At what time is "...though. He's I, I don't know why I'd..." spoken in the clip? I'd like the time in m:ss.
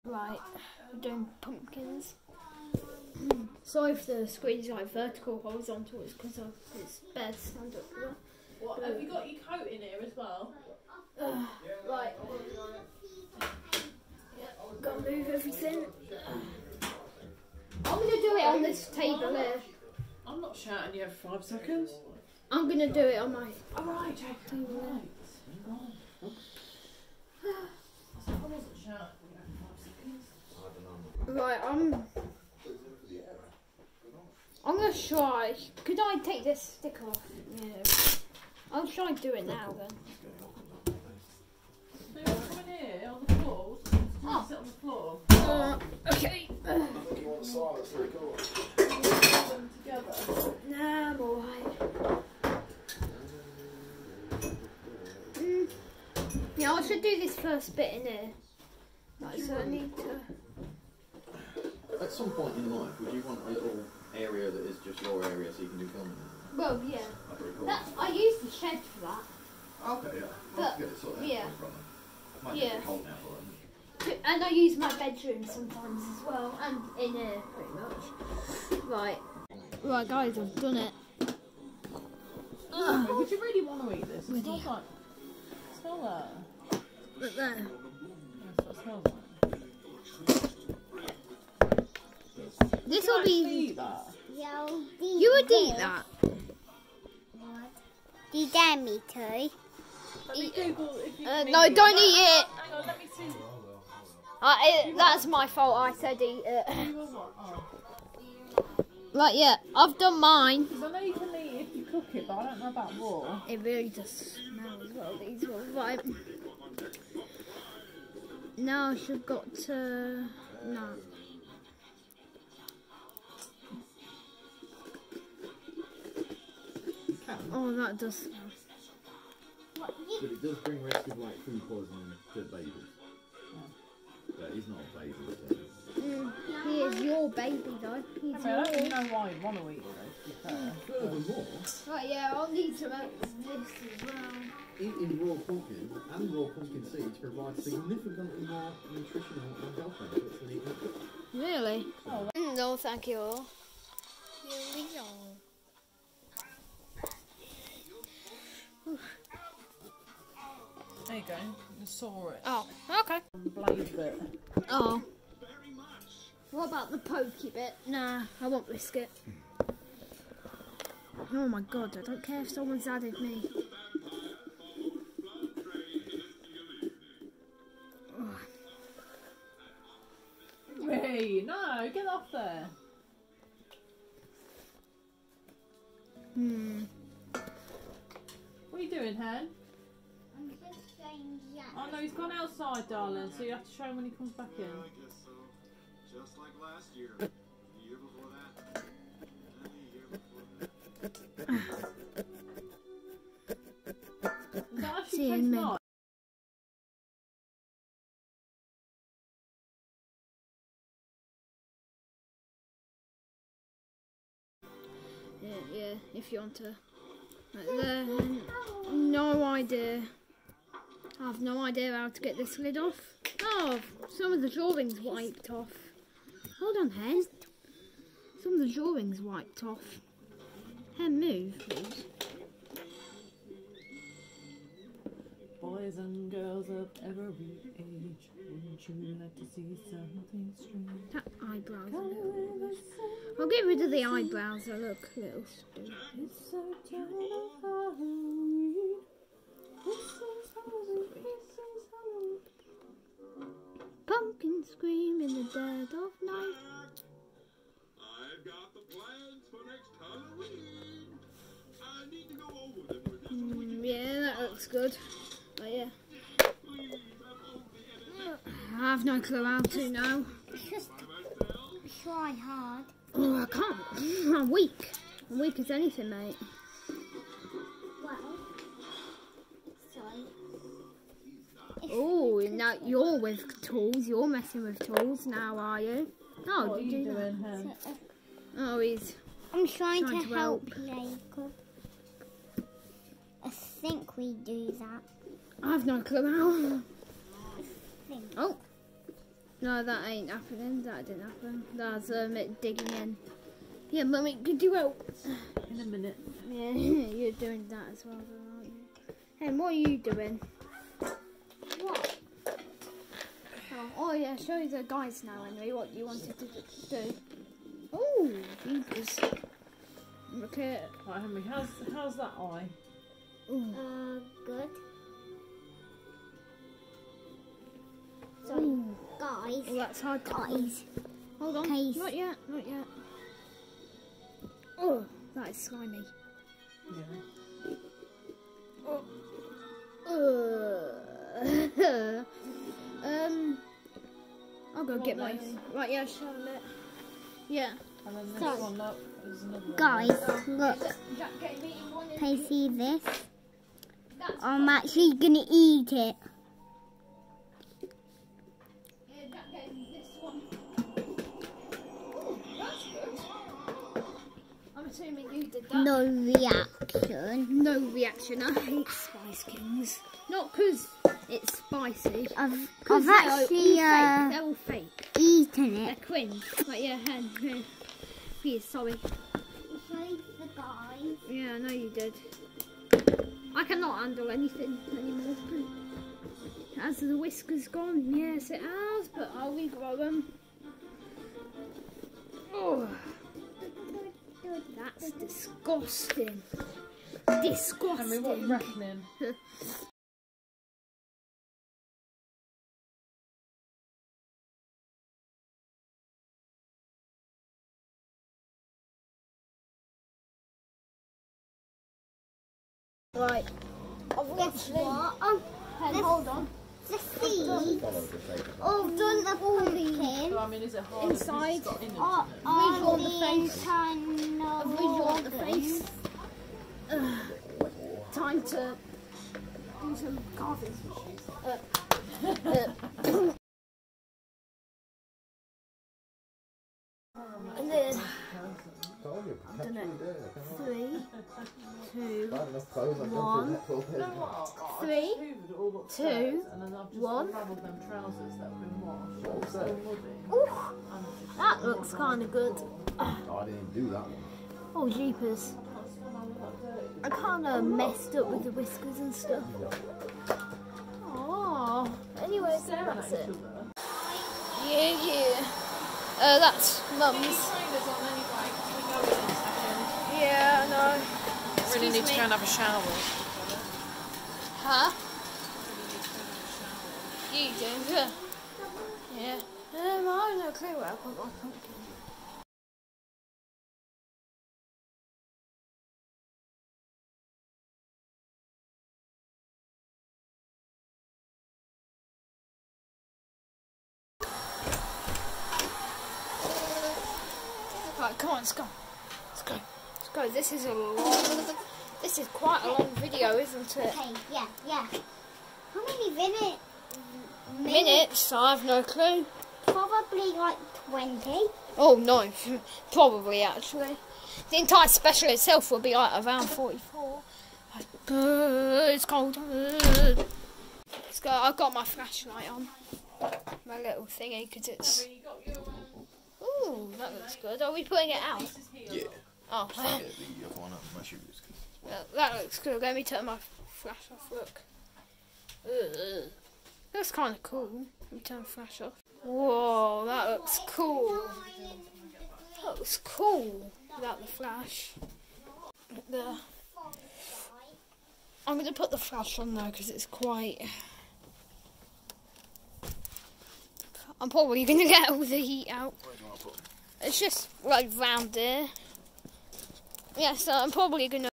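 2:17.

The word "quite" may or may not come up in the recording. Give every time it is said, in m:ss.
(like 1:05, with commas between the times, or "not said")
8:22, 9:10.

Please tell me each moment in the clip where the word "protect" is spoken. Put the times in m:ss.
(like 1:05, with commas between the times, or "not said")
not said.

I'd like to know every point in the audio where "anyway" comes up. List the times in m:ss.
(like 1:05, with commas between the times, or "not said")
5:15, 7:42.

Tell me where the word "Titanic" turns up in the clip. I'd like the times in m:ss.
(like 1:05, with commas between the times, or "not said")
not said.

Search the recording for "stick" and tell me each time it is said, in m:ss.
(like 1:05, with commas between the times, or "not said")
0:36.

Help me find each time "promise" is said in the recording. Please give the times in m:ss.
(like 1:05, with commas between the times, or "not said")
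not said.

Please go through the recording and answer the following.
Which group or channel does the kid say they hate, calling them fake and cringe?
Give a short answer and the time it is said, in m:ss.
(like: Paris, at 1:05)
Spice Kings, at 6:08.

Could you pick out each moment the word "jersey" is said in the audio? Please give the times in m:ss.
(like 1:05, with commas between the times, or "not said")
not said.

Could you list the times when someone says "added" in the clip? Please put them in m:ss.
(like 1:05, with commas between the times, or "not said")
2:52.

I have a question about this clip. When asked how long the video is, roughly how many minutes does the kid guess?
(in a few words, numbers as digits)
20.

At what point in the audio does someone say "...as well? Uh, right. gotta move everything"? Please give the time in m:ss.
0:10.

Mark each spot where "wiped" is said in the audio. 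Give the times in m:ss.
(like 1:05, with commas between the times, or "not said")
3:45, 3:49.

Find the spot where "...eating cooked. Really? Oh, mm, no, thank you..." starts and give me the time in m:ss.
2:30.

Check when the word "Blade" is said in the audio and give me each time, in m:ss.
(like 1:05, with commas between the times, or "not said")
2:43.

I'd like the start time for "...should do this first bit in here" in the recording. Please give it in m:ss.
0:56.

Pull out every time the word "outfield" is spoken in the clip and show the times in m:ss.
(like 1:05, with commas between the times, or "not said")
not said.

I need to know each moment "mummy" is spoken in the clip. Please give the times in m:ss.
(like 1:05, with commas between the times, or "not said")
5:04.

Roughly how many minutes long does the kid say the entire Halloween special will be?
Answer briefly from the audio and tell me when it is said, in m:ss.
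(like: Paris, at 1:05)
44, at 8:36.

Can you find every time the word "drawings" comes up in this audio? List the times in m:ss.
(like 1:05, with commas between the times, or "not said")
3:44, 3:48.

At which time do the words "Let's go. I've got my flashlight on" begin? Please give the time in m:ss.
8:39.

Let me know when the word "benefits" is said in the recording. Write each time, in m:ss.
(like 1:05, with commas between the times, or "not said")
2:29.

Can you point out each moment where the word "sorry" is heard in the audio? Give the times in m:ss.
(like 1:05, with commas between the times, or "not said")
0:03, 6:18.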